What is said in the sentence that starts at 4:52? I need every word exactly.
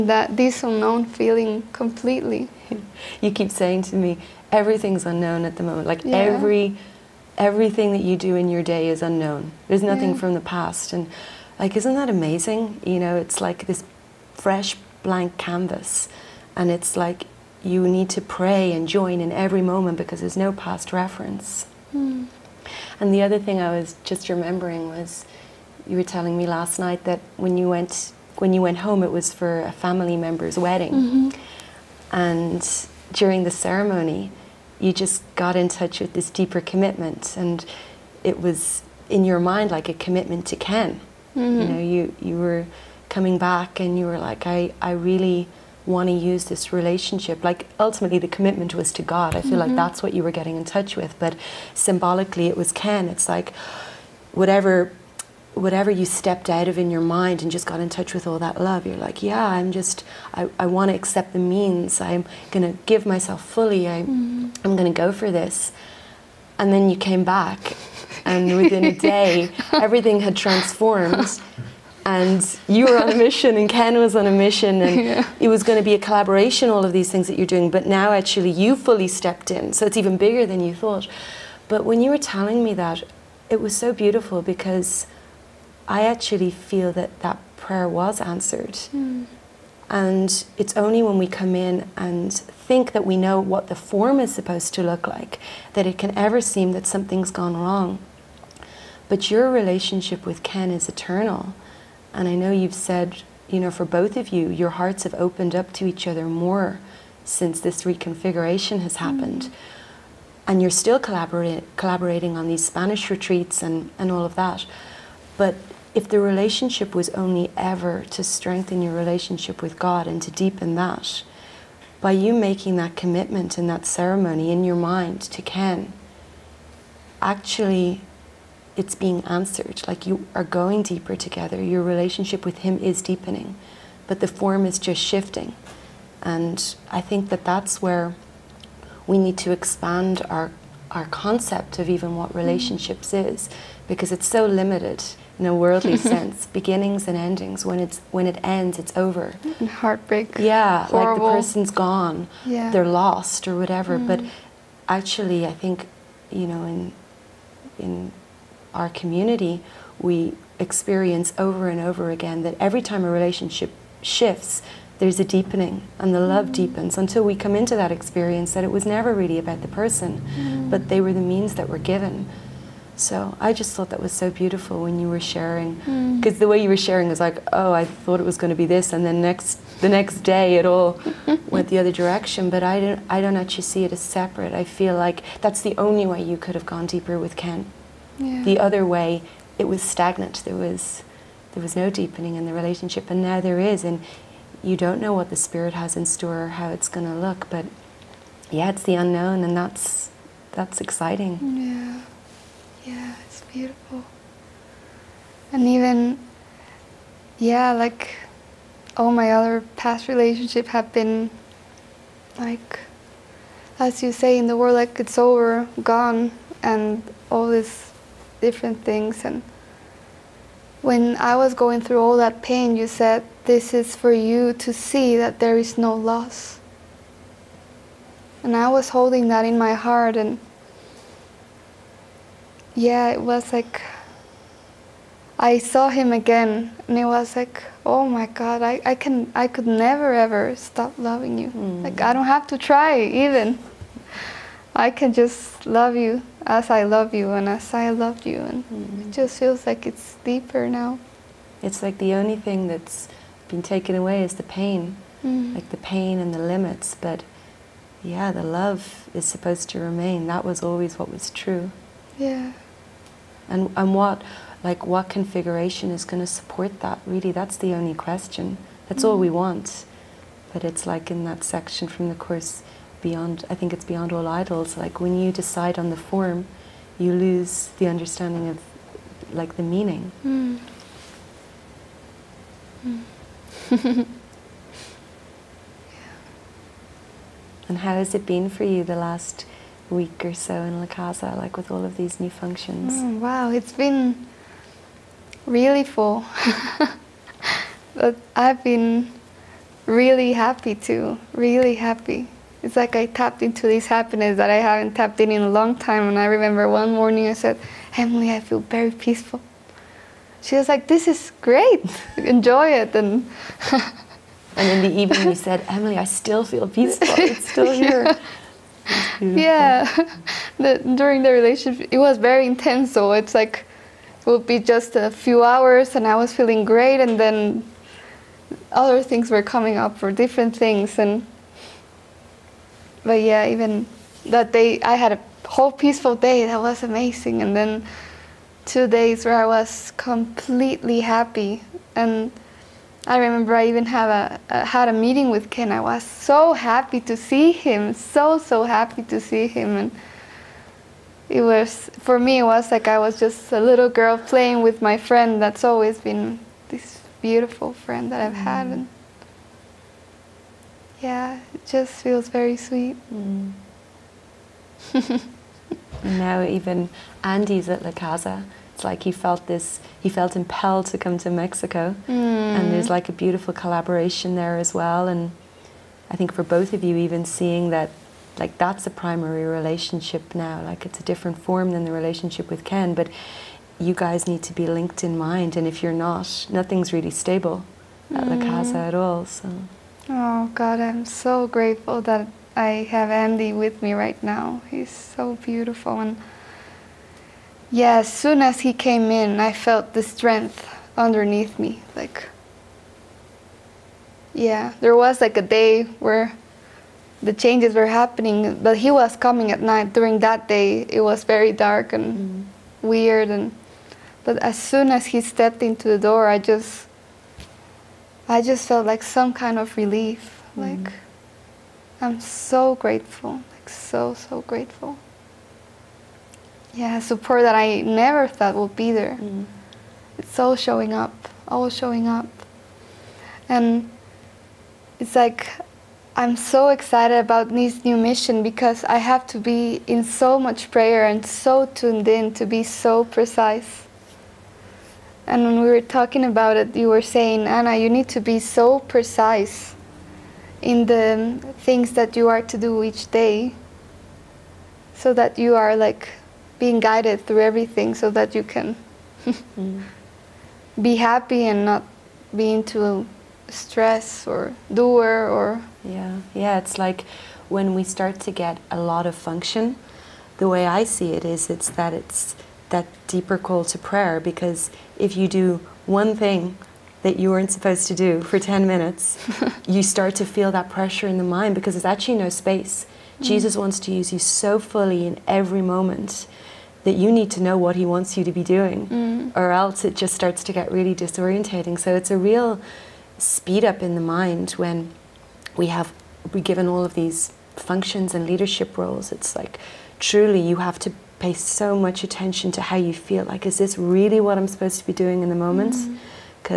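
Mm, wow, it's been really full.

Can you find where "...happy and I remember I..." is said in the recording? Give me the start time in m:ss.
5:41.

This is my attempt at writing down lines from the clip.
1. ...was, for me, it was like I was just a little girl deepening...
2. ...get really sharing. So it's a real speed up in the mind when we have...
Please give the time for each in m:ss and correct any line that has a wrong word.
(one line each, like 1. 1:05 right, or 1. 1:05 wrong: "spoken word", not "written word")
1. 5:51 wrong: "playing", not "deepening"
2. 8:10 wrong: "disorientating", not "sharing".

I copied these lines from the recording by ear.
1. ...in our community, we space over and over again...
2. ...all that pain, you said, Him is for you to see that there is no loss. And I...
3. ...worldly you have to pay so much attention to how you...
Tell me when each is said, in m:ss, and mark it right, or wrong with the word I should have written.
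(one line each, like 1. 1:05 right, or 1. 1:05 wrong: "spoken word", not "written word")
1. 2:37 wrong: "experience", not "space"
2. 3:42 wrong: "This", not "Him"
3. 8:19 wrong: "truly", not "worldly".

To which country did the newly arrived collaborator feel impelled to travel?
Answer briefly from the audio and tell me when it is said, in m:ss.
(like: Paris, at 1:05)
Mexico, at 6:11.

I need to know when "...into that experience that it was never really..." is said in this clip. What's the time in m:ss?
2:47.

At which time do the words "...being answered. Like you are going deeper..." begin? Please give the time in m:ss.
2:08.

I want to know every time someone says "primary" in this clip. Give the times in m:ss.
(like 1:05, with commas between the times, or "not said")
6:18.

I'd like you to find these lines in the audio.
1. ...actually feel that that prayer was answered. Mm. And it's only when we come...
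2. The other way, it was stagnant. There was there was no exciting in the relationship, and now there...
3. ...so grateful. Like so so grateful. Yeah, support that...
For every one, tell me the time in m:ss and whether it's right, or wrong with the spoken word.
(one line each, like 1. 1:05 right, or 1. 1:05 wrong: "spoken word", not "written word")
1. 1:26 right
2. 3:08 wrong: "deepening", not "exciting"
3. 7:02 right.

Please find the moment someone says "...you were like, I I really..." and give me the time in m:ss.
0:43.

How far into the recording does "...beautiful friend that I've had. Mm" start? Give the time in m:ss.
5:57.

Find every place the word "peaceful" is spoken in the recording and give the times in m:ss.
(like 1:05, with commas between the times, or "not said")
5:08, 5:16, 5:35.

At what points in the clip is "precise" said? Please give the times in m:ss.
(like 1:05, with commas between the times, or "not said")
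7:23, 7:28.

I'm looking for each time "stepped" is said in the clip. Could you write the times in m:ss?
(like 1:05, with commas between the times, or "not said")
0:56, 1:19, 6:55.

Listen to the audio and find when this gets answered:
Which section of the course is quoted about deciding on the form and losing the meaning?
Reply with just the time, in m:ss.
4:33.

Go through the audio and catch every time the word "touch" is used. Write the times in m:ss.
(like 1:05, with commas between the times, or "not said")
0:35, 0:50, 0:57.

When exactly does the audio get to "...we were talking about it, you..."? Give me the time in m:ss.
7:25.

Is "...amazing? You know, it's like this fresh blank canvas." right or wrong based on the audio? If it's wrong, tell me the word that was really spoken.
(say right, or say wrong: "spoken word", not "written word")
right.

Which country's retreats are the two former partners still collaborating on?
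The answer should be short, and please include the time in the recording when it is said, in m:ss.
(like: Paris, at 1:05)
Spanish retreats, at 1:52.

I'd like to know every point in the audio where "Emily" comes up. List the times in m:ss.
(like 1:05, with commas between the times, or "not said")
5:07, 5:15.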